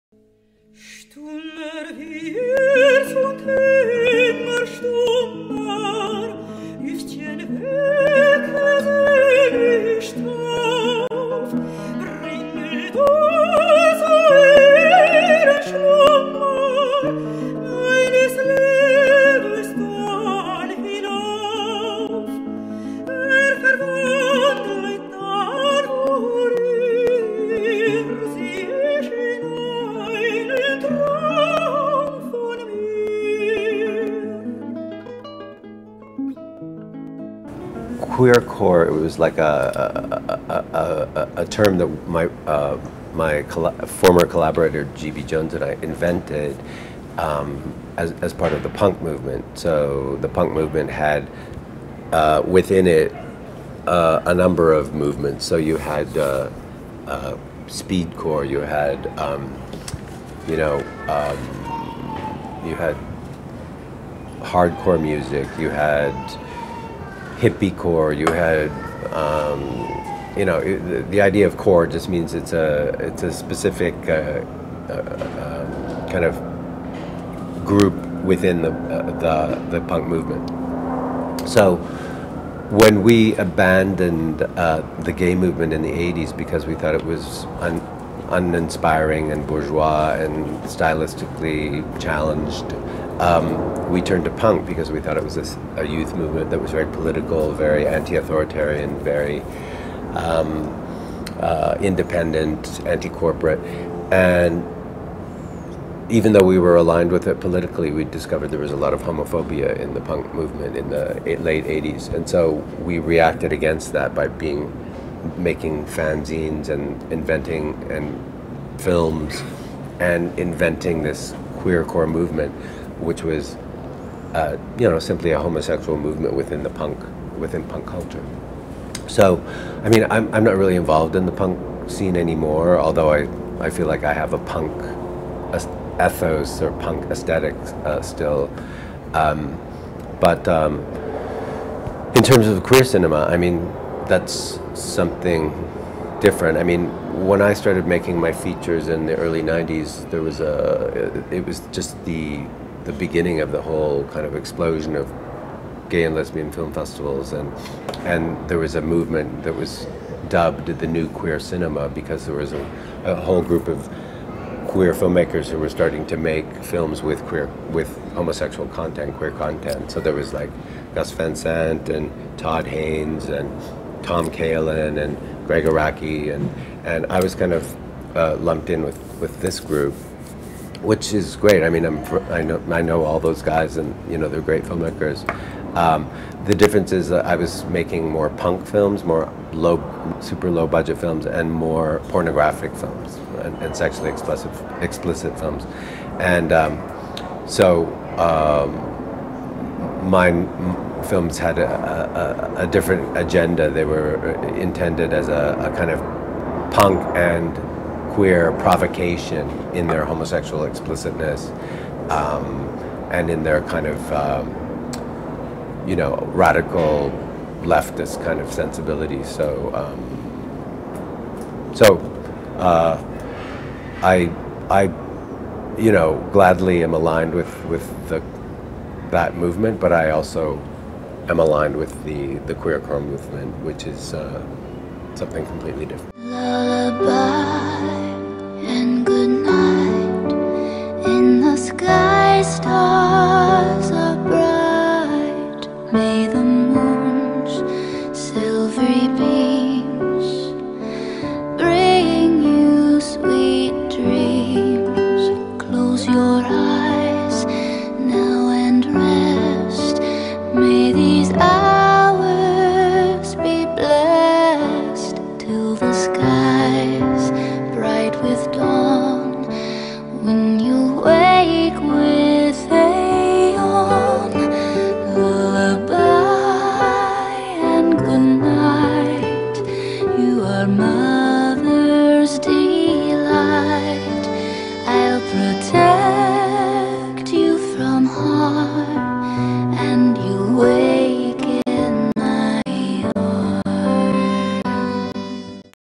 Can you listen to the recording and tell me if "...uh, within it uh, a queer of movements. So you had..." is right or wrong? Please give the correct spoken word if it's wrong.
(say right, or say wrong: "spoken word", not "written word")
wrong: "number", not "queer".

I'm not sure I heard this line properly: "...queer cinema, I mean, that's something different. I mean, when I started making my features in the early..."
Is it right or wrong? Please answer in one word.
right.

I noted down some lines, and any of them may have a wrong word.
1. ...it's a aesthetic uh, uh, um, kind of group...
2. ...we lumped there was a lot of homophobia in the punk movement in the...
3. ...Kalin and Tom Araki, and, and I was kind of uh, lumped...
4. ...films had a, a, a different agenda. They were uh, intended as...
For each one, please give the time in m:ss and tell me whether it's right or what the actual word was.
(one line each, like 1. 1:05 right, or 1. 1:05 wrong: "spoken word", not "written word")
1. 1:12 wrong: "specific", not "aesthetic"
2. 1:47 wrong: "discovered", not "lumped"
3. 2:54 wrong: "Gregg", not "Tom"
4. 3:21 right.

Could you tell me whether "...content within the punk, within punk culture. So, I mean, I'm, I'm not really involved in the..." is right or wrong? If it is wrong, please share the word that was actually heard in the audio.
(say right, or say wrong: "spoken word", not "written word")
wrong: "movement", not "content".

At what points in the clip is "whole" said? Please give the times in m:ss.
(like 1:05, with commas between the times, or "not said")
2:33, 2:43.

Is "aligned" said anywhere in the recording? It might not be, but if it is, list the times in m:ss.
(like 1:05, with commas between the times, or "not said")
1:46, 3:46, 3:51.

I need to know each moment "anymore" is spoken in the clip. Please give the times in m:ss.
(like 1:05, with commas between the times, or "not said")
2:12.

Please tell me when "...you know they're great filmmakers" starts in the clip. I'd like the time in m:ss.
3:04.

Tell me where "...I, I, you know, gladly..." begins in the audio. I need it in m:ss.
3:44.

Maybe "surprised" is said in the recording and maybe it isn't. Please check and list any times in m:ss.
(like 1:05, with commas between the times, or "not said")
not said.